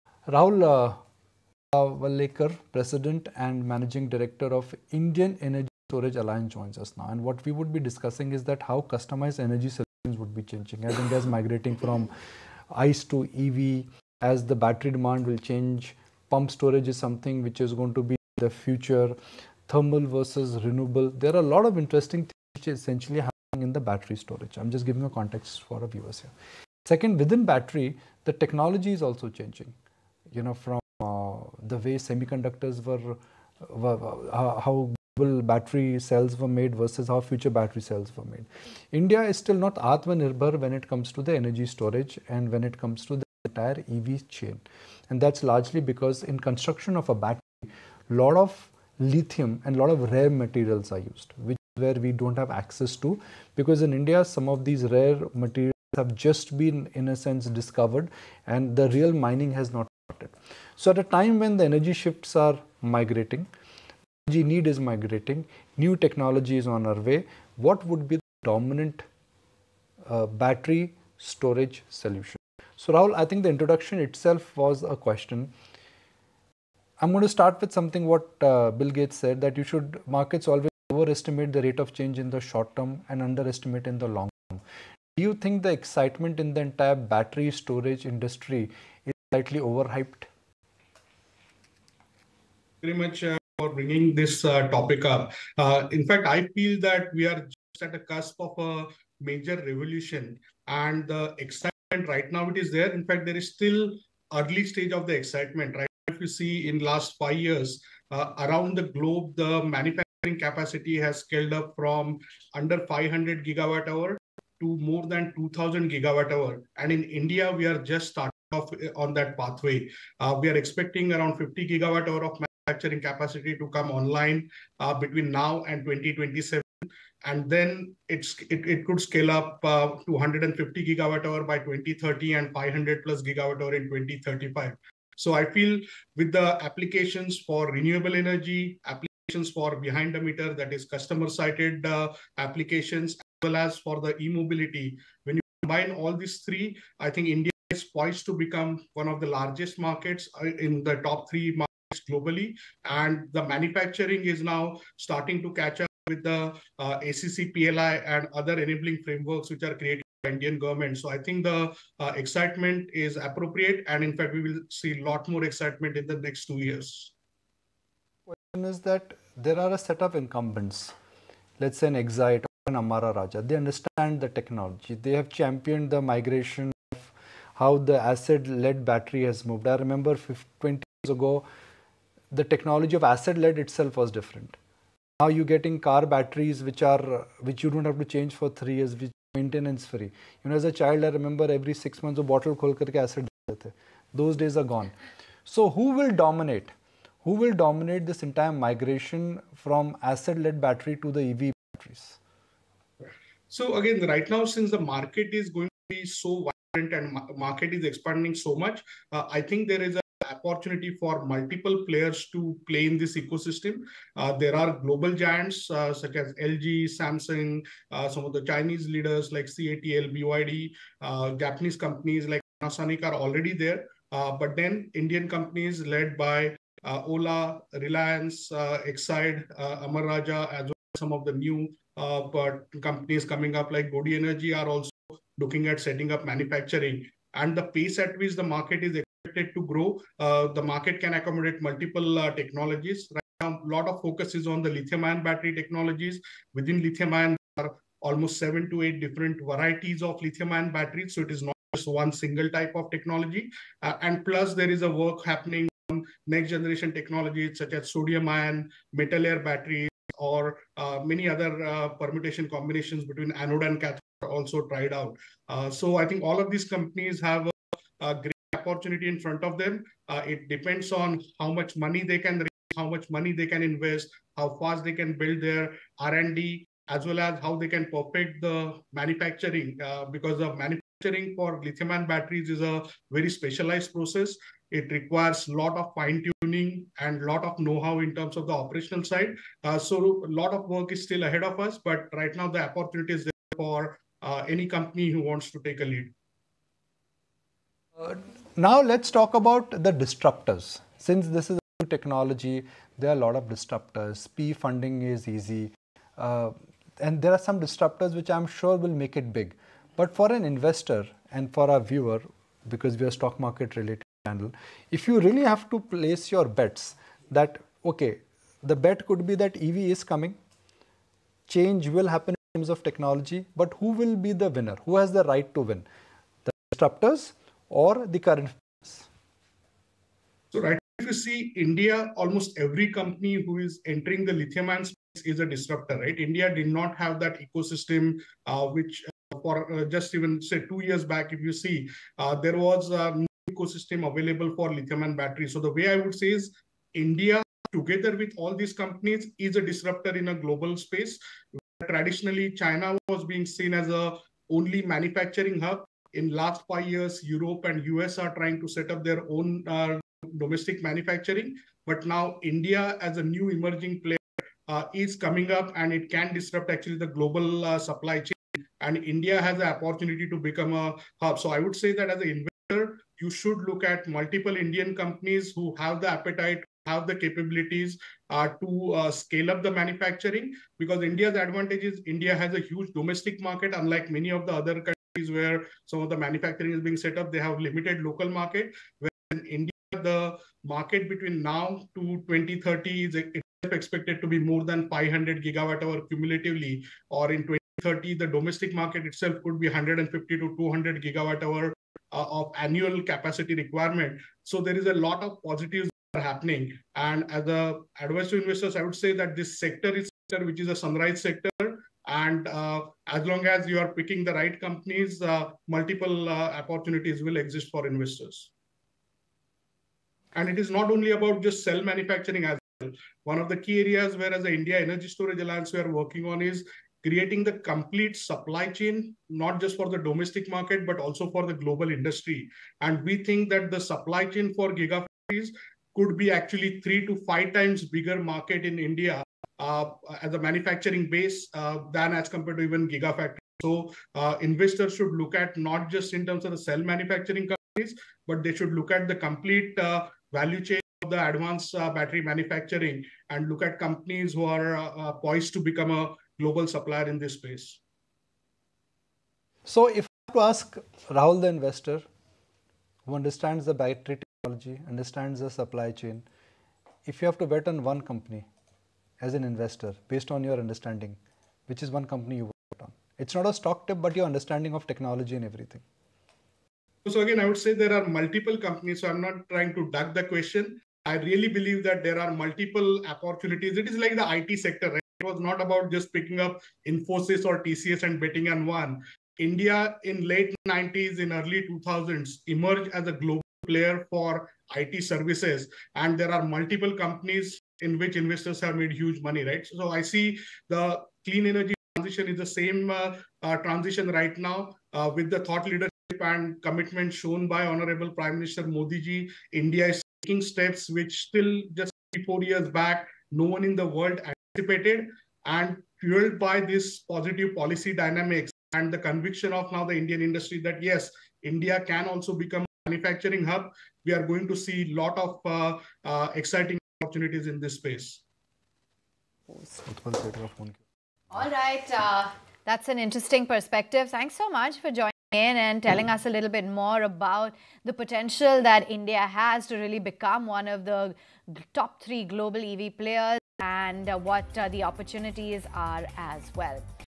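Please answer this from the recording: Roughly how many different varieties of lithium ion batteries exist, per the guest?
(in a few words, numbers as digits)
7 to 8.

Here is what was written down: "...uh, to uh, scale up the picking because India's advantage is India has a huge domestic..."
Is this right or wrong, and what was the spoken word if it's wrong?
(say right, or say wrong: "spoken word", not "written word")
wrong: "manufacturing", not "picking".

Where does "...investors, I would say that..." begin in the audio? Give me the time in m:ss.
6:48.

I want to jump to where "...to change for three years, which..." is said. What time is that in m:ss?
3:07.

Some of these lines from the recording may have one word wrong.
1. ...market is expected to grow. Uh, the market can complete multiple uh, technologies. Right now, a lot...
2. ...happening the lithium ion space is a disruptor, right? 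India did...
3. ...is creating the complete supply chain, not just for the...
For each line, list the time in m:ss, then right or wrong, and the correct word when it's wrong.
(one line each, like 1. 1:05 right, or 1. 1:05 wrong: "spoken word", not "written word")
1. 3:58 wrong: "accommodate", not "complete"
2. 5:33 wrong: "entering", not "happening"
3. 7:06 right.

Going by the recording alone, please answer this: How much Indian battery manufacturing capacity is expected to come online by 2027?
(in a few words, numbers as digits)
50 gigawatt hour.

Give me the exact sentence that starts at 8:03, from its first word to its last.
It is like the IT sector, right?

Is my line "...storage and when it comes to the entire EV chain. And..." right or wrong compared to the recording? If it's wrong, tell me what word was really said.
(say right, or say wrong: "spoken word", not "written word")
right.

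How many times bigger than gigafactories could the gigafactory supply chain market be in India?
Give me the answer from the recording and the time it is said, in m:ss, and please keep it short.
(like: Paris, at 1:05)
3 to 5 times, at 7:16.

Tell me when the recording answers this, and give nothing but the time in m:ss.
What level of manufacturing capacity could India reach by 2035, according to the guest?
2:12.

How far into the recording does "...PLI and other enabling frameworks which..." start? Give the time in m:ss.
2:37.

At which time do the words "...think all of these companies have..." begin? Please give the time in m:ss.
4:26.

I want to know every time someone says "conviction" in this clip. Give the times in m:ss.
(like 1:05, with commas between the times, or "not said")
8:38.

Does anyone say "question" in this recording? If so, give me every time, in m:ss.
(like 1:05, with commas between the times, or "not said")
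1:14, 2:48, 8:00.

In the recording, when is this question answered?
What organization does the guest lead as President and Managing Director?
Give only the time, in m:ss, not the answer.
0:04.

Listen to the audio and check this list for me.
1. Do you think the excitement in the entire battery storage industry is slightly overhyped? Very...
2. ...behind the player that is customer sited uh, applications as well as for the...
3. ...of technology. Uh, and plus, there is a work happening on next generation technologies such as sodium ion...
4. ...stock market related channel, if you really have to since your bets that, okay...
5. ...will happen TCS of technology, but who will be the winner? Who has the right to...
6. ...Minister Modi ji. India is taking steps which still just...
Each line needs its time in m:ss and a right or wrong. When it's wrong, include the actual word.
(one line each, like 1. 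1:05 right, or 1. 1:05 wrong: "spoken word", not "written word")
1. 1:25 right
2. 2:19 wrong: "meter", not "player"
3. 4:12 right
4. 5:13 wrong: "place", not "since"
5. 5:21 wrong: "Terms", not "TCS"
6. 8:28 right.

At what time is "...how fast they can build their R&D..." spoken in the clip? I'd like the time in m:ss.
4:34.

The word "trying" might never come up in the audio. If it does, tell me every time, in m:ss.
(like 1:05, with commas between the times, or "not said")
5:58, 7:59.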